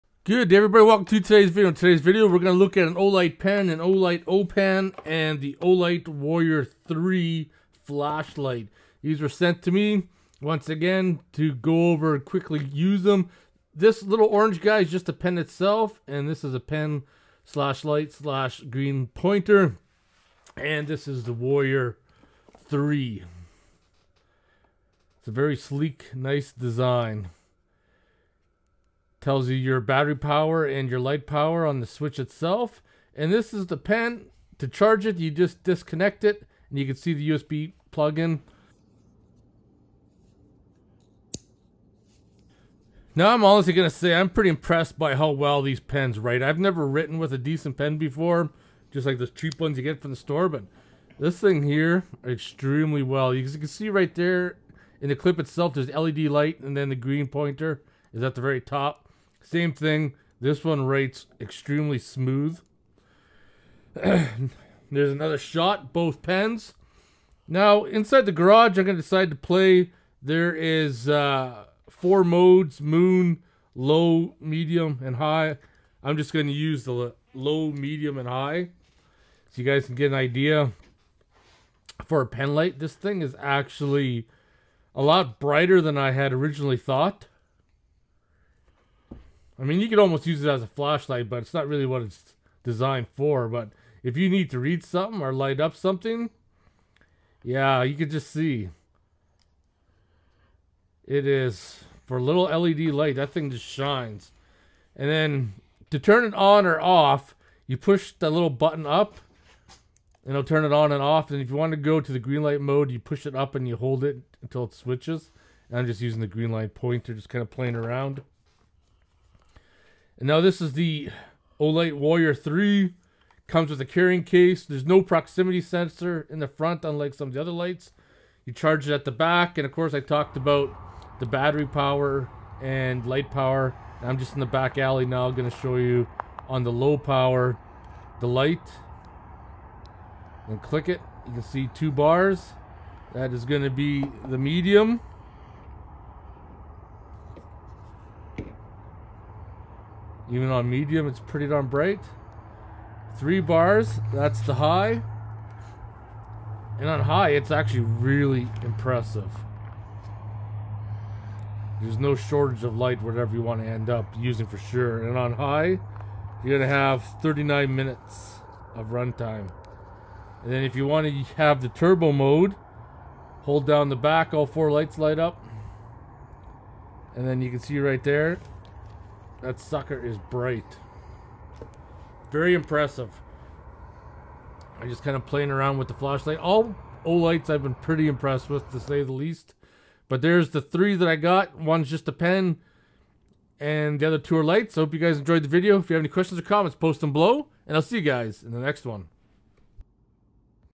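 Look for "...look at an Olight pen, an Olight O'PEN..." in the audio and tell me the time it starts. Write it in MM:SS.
00:02.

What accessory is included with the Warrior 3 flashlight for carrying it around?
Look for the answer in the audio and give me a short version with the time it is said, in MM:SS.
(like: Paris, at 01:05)
Carrying case, at 02:03.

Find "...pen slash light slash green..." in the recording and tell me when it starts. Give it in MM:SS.
00:16.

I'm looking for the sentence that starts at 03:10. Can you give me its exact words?
But there's the three that I got.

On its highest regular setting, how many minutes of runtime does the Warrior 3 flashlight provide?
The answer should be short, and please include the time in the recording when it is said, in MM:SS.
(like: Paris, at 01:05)
39 minutes, at 02:47.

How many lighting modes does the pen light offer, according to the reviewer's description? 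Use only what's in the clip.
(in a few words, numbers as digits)
4.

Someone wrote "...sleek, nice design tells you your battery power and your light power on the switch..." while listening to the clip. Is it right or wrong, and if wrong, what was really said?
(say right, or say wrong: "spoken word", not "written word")
right.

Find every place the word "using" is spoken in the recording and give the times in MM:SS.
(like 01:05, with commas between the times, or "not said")
01:56, 02:44.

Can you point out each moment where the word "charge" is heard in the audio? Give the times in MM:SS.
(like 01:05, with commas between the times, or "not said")
00:34, 02:08.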